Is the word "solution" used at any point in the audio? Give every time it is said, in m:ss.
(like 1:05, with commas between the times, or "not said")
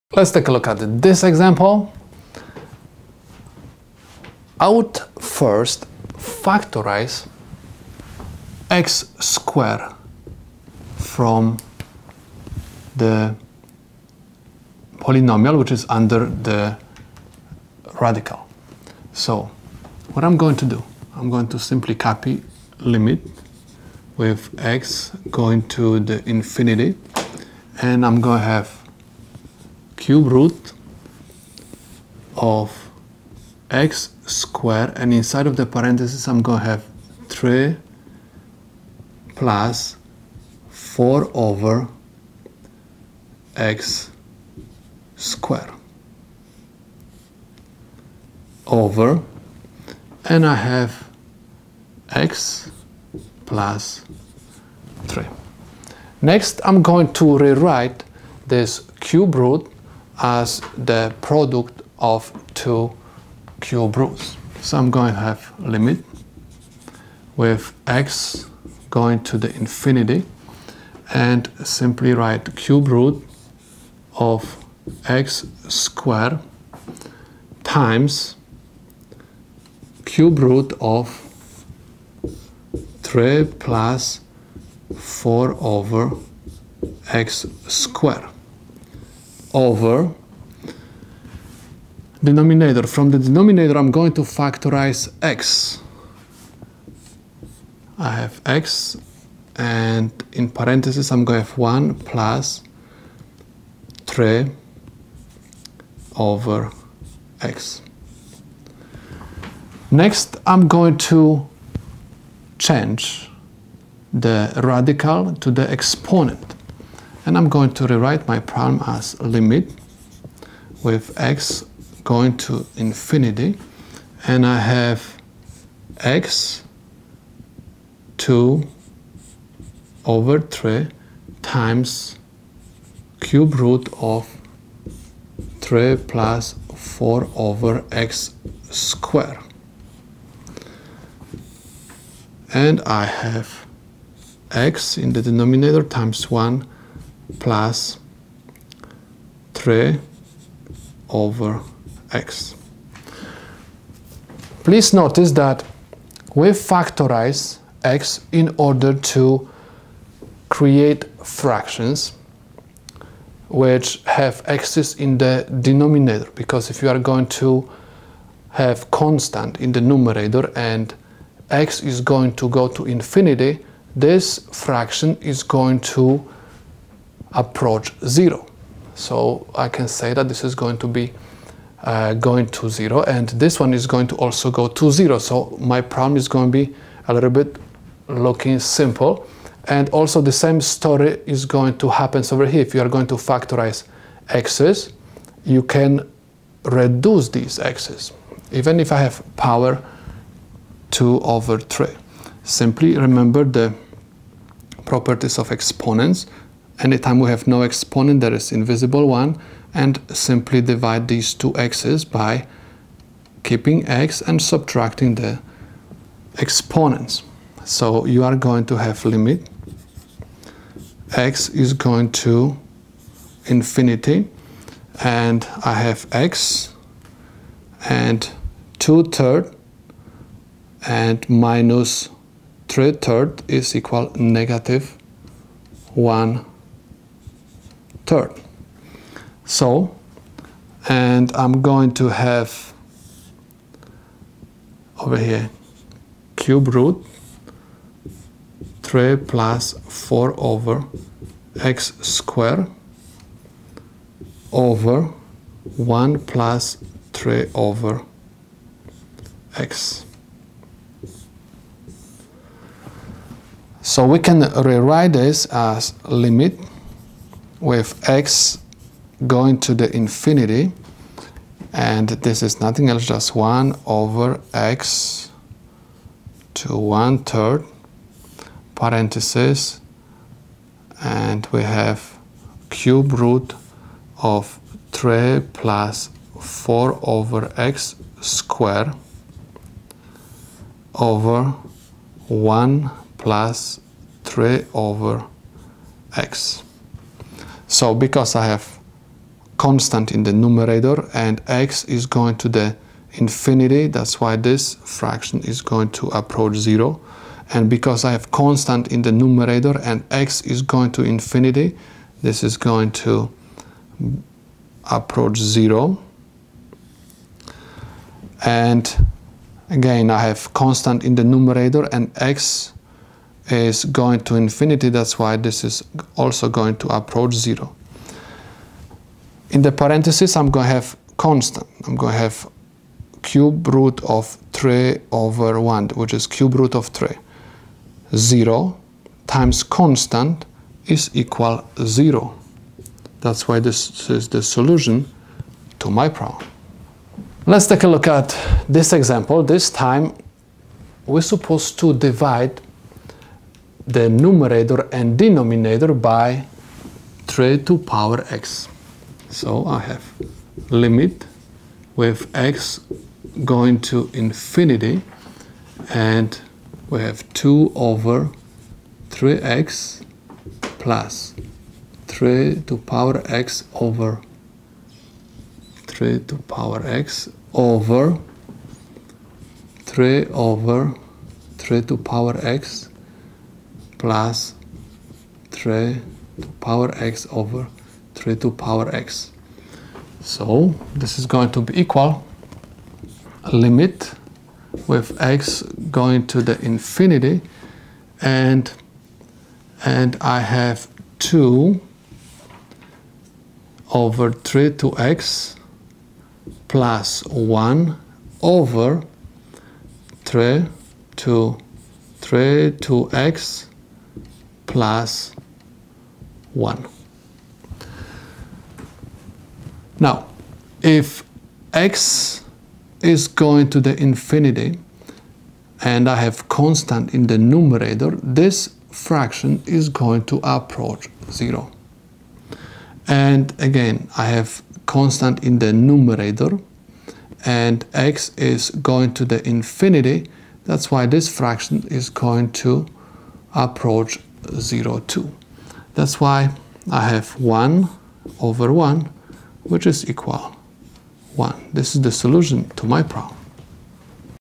5:44, 7:32.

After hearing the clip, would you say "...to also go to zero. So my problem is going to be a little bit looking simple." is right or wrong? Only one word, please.
right.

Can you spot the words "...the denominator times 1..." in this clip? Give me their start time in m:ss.
2:25.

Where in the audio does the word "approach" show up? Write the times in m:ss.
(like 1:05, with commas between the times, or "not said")
2:57, 5:06, 5:14, 5:26, 7:10, 7:23.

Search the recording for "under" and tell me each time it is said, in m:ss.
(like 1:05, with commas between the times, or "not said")
0:15.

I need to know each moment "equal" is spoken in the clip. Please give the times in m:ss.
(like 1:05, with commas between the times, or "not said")
3:53, 5:41, 6:31, 7:30.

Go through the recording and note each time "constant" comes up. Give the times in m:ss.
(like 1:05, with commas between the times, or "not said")
2:48, 4:59, 5:08, 5:20, 5:31, 5:39, 7:06, 7:14.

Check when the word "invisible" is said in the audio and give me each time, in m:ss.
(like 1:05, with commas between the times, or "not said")
3:28.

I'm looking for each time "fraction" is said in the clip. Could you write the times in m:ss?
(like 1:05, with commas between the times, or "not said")
2:41, 2:54, 5:04, 7:08, 7:21.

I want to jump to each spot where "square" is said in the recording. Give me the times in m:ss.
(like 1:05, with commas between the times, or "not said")
0:09, 0:34, 0:45, 1:15, 1:27, 2:18, 4:12, 4:48.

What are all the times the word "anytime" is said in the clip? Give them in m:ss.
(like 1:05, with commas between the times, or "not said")
3:26.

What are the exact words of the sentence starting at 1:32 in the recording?
From the denominator, I'm going to factorize x.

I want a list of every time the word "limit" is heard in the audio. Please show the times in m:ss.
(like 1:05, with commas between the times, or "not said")
0:22, 1:05, 1:59, 3:39, 4:26, 6:00, 6:33.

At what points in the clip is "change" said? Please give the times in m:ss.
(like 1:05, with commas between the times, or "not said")
1:52.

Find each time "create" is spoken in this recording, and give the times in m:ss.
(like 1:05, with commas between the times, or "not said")
2:40.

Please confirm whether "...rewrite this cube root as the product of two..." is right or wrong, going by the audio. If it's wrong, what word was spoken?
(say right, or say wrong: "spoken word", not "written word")
right.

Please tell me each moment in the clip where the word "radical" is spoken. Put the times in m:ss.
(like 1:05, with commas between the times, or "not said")
0:18, 1:54.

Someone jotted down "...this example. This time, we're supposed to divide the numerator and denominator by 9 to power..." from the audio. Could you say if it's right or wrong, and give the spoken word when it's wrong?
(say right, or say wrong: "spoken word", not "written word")
wrong: "3", not "9".